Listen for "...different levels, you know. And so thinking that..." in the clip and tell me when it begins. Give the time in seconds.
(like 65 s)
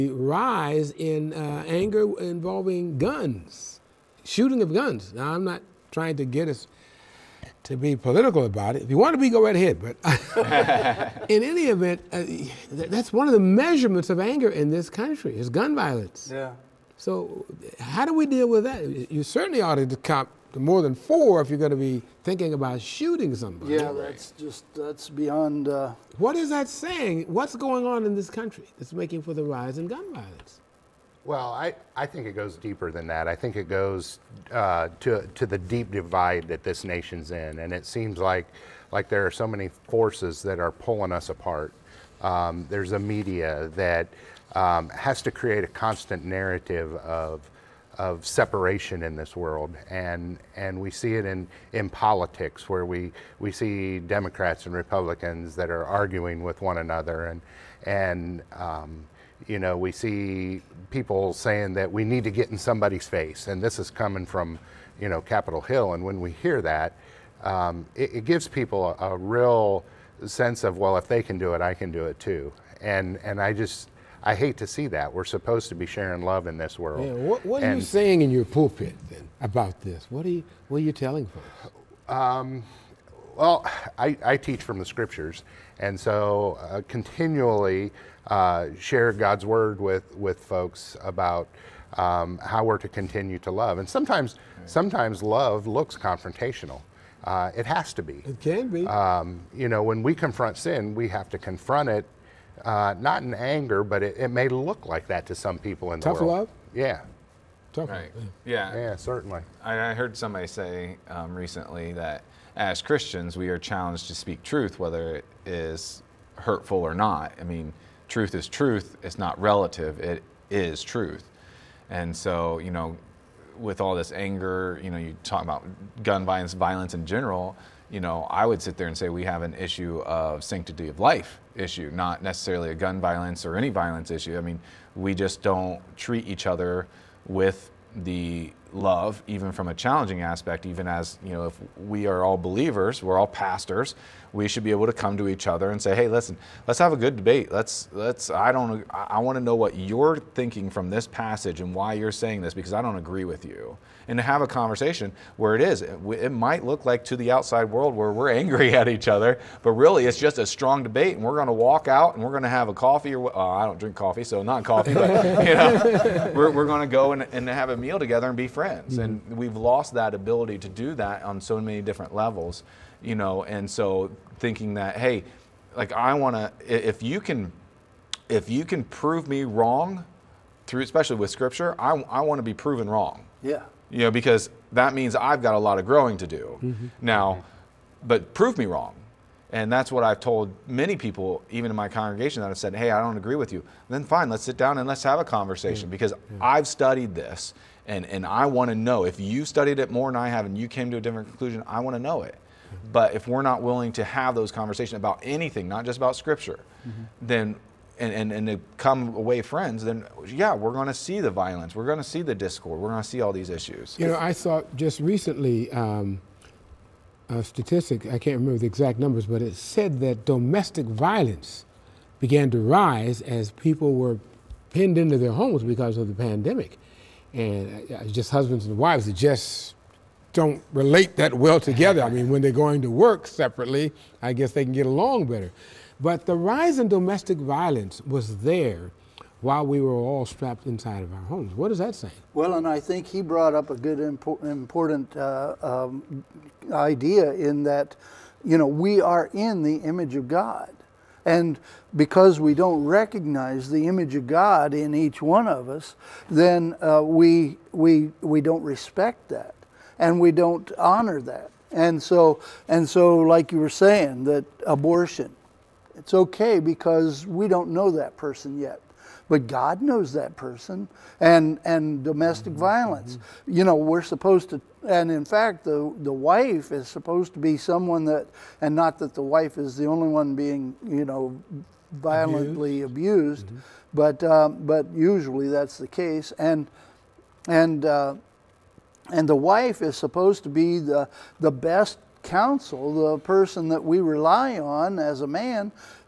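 171 s.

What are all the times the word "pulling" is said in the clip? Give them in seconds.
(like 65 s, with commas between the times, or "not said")
40 s.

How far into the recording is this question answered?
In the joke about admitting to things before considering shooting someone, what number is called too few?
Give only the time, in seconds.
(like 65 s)
20 s.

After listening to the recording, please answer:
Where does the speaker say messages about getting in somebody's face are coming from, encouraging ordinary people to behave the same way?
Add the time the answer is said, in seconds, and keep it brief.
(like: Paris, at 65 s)
Capitol Hill, at 65 s.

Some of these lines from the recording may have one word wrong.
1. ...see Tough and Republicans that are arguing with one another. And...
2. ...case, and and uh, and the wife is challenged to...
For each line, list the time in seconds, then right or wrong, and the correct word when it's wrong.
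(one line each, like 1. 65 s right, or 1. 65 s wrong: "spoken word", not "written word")
1. 53 s wrong: "Democrats", not "Tough"
2. 285 s wrong: "supposed", not "challenged".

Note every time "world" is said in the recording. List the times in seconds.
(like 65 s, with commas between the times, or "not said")
49 s, 76 s, 106 s, 157 s.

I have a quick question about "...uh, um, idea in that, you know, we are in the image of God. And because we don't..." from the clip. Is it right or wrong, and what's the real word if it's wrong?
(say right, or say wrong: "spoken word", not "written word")
right.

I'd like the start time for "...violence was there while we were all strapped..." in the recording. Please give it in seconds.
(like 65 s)
237 s.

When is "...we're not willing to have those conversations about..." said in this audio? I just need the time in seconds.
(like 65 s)
203 s.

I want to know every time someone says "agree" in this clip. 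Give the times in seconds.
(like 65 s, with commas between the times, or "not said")
152 s, 193 s.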